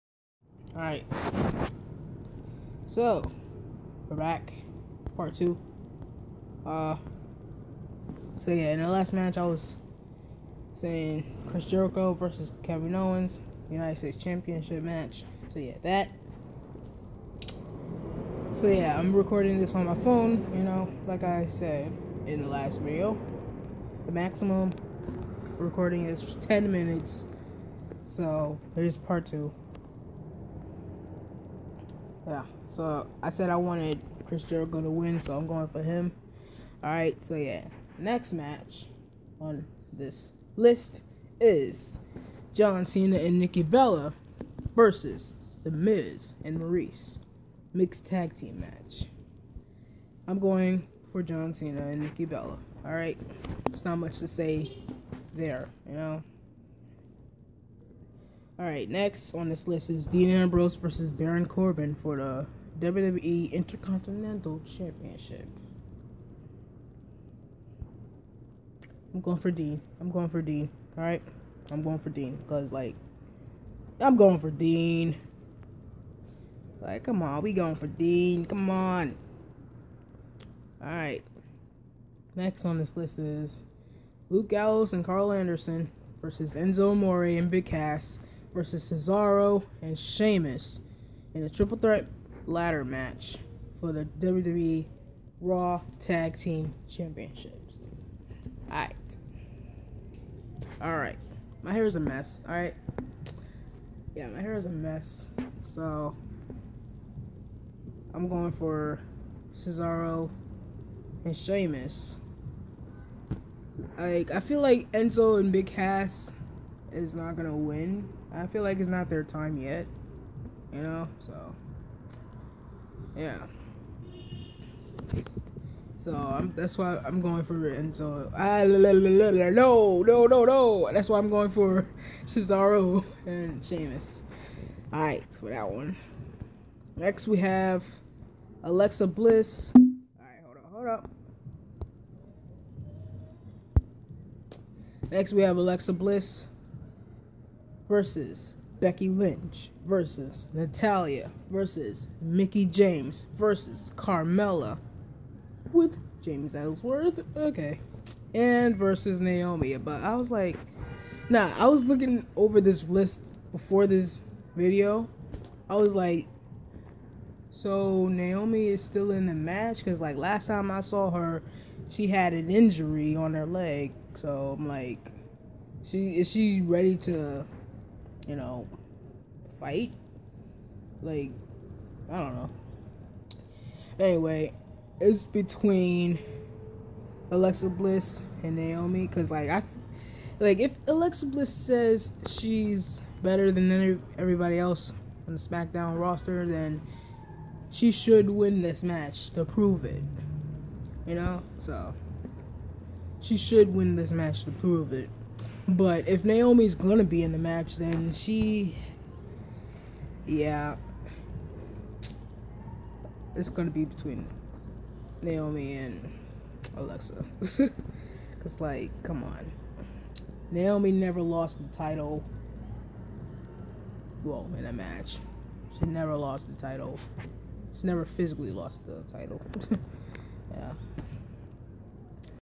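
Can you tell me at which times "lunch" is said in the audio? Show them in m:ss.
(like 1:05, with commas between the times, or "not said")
not said.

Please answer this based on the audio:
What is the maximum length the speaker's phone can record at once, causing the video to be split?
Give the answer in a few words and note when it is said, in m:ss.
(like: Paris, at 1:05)
10 minutes, at 0:26.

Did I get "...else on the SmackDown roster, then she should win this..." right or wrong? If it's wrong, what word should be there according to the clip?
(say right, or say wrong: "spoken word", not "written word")
right.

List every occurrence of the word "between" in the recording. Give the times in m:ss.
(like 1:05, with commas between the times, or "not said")
3:05, 3:33.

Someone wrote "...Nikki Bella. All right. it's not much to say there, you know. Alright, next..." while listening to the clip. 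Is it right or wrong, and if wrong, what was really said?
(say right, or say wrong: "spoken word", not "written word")
right.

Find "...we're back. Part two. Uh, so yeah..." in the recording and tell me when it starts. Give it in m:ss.
0:04.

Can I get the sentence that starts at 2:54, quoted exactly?
So I'm like, she is she ready to you know, fight.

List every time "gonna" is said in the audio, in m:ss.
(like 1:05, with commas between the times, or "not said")
1:57, 3:26, 3:33.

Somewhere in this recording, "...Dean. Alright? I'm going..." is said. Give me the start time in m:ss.
1:10.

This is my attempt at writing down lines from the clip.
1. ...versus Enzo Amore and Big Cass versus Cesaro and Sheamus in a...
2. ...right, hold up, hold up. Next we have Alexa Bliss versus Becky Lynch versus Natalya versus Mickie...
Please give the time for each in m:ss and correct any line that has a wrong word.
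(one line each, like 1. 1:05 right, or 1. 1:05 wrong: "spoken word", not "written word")
1. 1:26 right
2. 2:20 right.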